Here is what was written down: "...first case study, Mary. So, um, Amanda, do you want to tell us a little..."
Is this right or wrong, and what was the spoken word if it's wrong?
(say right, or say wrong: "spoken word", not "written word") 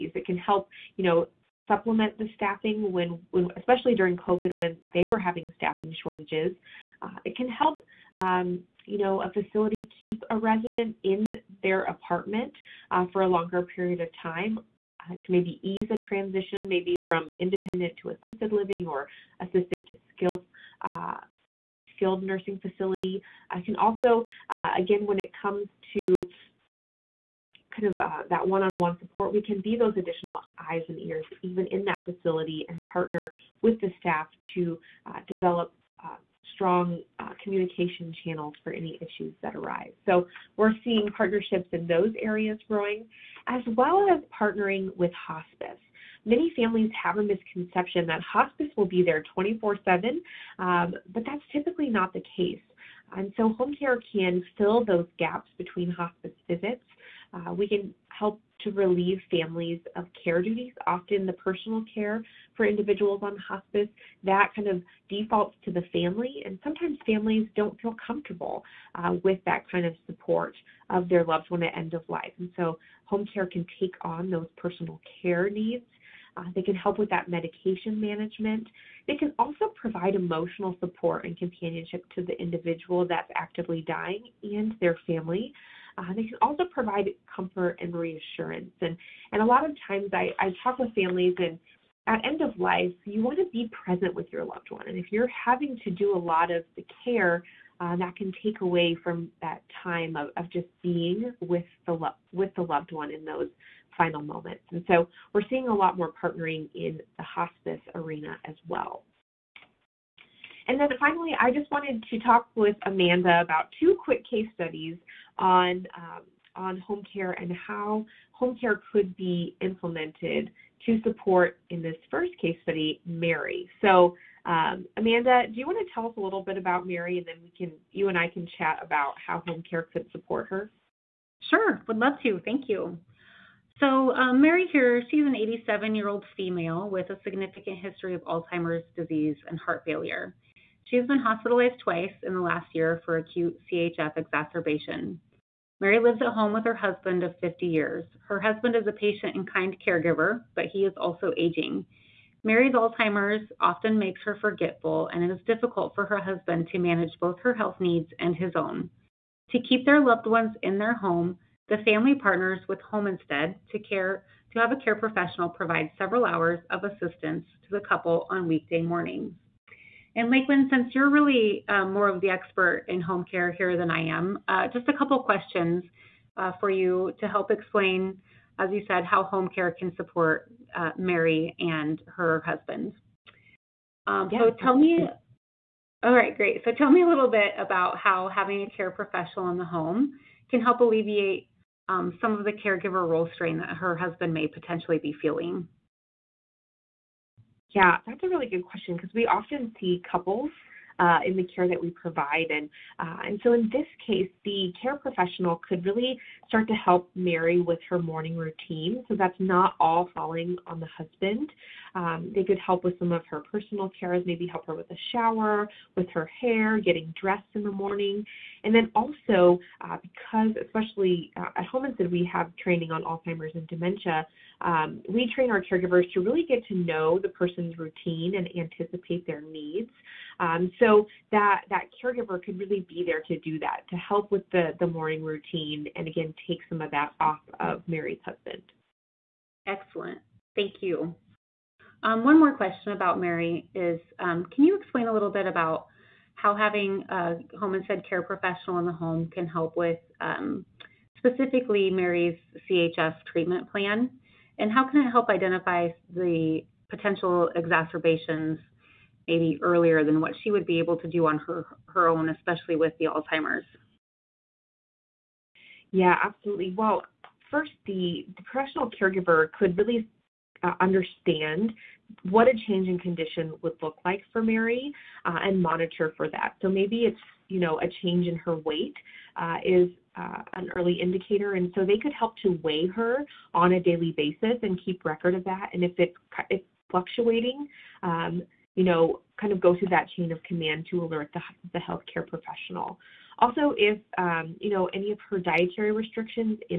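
right.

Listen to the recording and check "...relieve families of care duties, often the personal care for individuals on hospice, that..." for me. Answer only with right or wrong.
right.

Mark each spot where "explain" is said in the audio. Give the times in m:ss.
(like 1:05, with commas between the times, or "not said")
2:57, 4:04.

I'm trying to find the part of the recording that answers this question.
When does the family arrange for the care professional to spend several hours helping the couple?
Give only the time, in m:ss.
2:48.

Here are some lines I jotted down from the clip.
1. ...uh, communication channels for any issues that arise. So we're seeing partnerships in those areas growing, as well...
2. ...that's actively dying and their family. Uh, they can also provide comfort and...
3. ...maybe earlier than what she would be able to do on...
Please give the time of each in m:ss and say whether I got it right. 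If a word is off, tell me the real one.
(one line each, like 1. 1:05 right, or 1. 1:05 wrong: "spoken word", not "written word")
1. 0:37 right
2. 1:23 right
3. 4:19 right.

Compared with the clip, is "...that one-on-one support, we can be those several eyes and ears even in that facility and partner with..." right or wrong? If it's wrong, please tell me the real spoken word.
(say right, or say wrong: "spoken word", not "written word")
wrong: "additional", not "several".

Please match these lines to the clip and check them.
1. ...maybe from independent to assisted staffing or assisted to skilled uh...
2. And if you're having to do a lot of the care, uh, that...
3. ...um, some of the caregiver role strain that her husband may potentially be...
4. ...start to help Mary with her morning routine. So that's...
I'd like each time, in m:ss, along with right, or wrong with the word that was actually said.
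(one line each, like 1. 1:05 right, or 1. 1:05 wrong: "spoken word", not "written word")
1. 0:16 wrong: "living", not "staffing"
2. 1:34 right
3. 3:11 right
4. 3:26 right.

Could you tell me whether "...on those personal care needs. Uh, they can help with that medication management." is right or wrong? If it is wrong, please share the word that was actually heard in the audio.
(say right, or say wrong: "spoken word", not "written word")
right.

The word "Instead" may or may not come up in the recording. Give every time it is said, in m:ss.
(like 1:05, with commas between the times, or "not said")
2:43, 3:41, 4:07.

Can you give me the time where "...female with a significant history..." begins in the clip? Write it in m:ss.
2:16.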